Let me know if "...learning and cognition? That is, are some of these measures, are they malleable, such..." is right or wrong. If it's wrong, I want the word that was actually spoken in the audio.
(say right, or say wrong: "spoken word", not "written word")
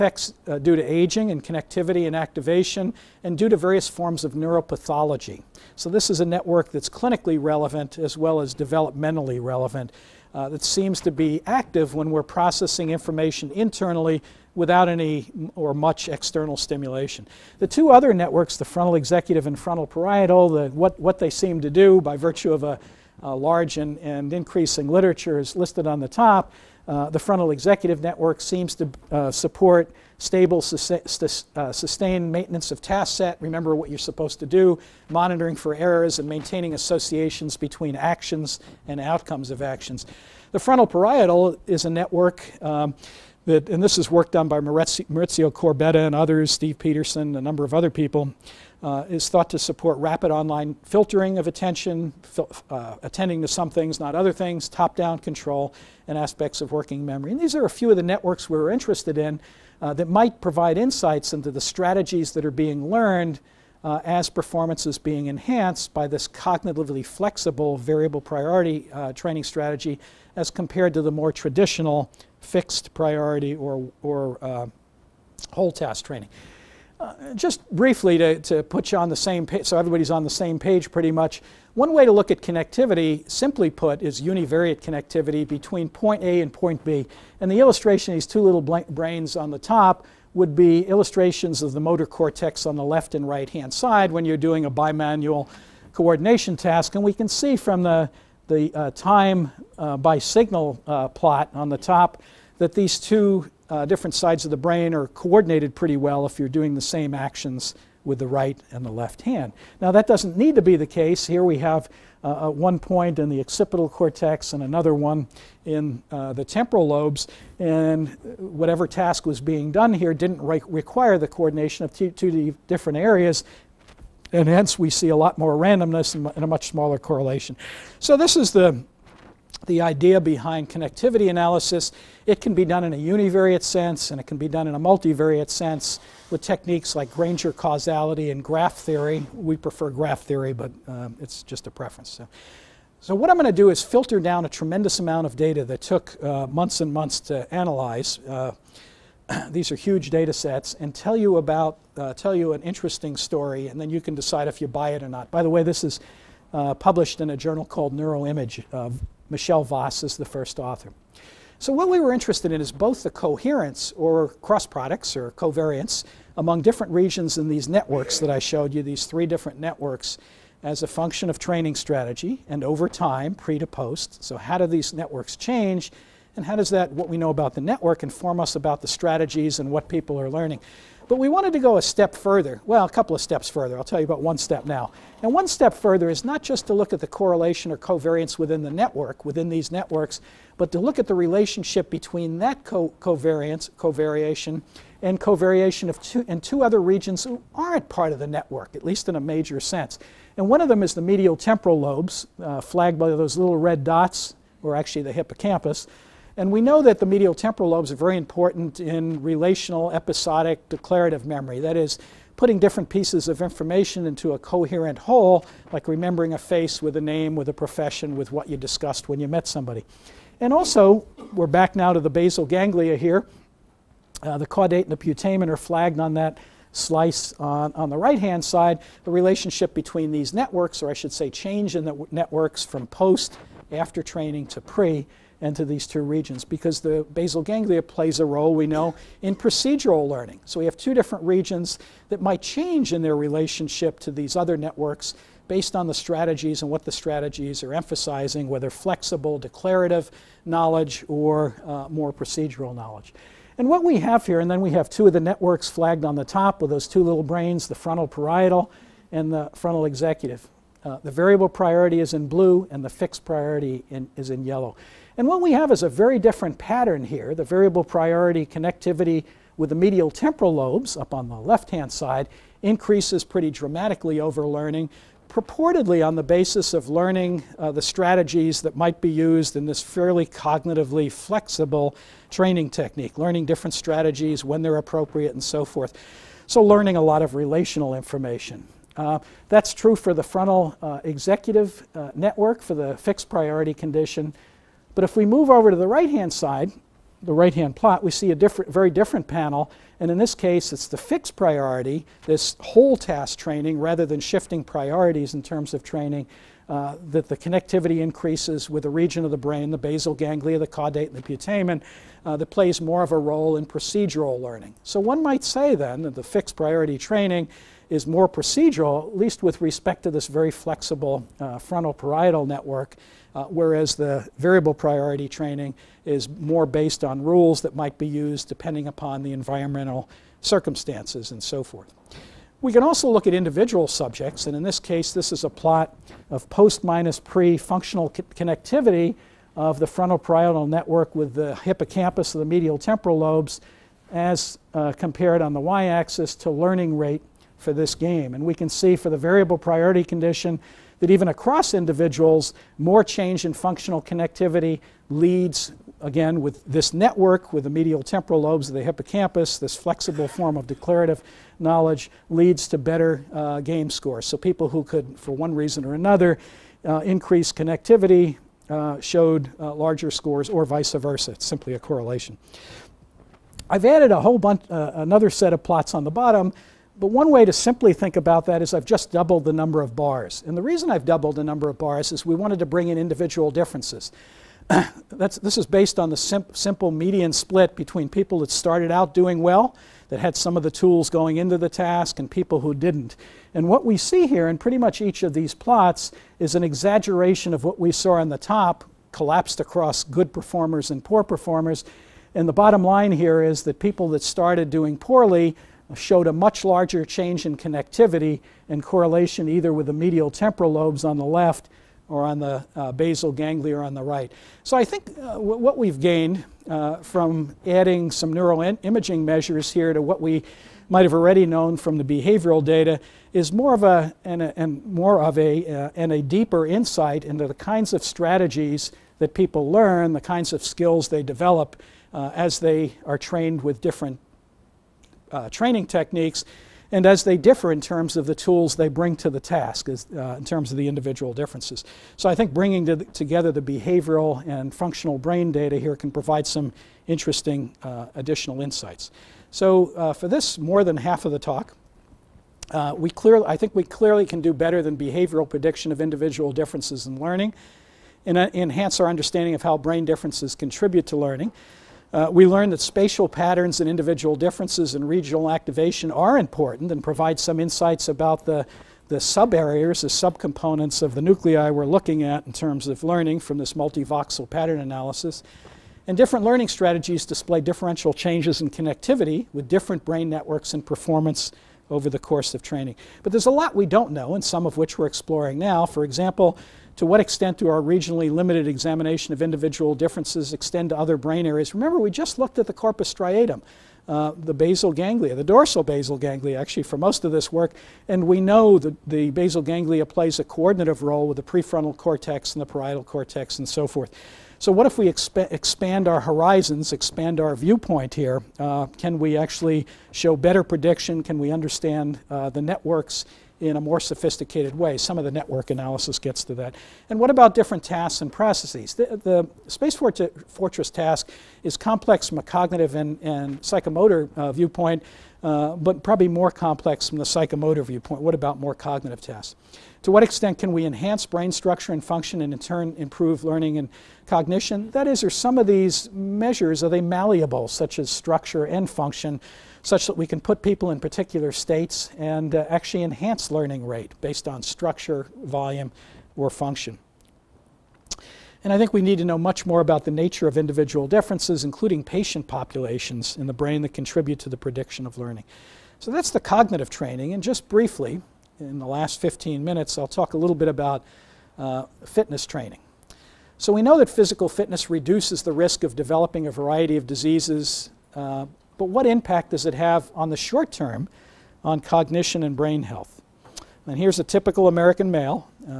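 right.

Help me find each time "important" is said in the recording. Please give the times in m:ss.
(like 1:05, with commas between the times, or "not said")
3:28, 7:46.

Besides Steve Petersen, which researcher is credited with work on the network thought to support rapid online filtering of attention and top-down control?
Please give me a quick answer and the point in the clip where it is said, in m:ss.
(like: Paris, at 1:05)
Maurizio Corbetta, at 0:44.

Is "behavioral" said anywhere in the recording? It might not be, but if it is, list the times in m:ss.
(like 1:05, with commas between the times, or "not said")
7:02, 7:23, 7:34.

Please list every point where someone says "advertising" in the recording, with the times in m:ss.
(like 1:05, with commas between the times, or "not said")
not said.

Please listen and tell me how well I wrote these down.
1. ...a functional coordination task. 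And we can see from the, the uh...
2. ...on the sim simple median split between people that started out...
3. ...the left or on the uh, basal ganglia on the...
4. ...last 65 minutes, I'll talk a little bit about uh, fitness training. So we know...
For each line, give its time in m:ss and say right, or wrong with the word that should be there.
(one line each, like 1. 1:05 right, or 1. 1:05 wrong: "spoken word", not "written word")
1. 1:34 wrong: "bimanual", not "functional"
2. 6:25 right
3. 6:51 right
4. 9:18 wrong: "15", not "65".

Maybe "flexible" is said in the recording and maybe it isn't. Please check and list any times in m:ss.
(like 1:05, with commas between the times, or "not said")
1:07, 4:08, 4:41, 5:20, 5:59.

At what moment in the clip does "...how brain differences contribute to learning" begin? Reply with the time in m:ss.
7:39.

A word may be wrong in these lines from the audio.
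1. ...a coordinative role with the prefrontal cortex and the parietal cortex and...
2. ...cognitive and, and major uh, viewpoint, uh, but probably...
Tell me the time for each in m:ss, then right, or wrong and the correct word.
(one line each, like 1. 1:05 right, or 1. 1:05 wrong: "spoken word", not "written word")
1. 8:20 right
2. 8:42 wrong: "psychomotor", not "major".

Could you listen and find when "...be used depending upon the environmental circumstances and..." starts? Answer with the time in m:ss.
5:27.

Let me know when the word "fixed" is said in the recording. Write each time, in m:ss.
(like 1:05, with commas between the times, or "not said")
1:12, 4:22, 4:52, 5:00, 5:16.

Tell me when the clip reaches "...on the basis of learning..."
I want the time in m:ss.
4:36.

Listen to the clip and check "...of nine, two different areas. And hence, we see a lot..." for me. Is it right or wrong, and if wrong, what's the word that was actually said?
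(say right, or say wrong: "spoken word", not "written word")
wrong: "two", not "nine".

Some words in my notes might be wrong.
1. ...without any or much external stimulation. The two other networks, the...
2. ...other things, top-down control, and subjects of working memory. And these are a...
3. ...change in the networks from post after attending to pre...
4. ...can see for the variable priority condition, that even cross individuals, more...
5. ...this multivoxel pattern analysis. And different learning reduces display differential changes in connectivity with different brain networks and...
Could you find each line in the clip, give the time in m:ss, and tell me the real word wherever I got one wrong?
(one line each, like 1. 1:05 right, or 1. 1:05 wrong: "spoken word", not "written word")
1. 0:14 right
2. 0:54 wrong: "aspects", not "subjects"
3. 3:51 wrong: "training", not "attending"
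4. 5:48 wrong: "across", not "cross"
5. 7:53 wrong: "strategies", not "reduces".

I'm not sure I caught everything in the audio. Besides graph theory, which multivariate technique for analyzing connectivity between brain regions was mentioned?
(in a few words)
Granger causality.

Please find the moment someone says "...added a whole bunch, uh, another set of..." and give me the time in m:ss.
6:13.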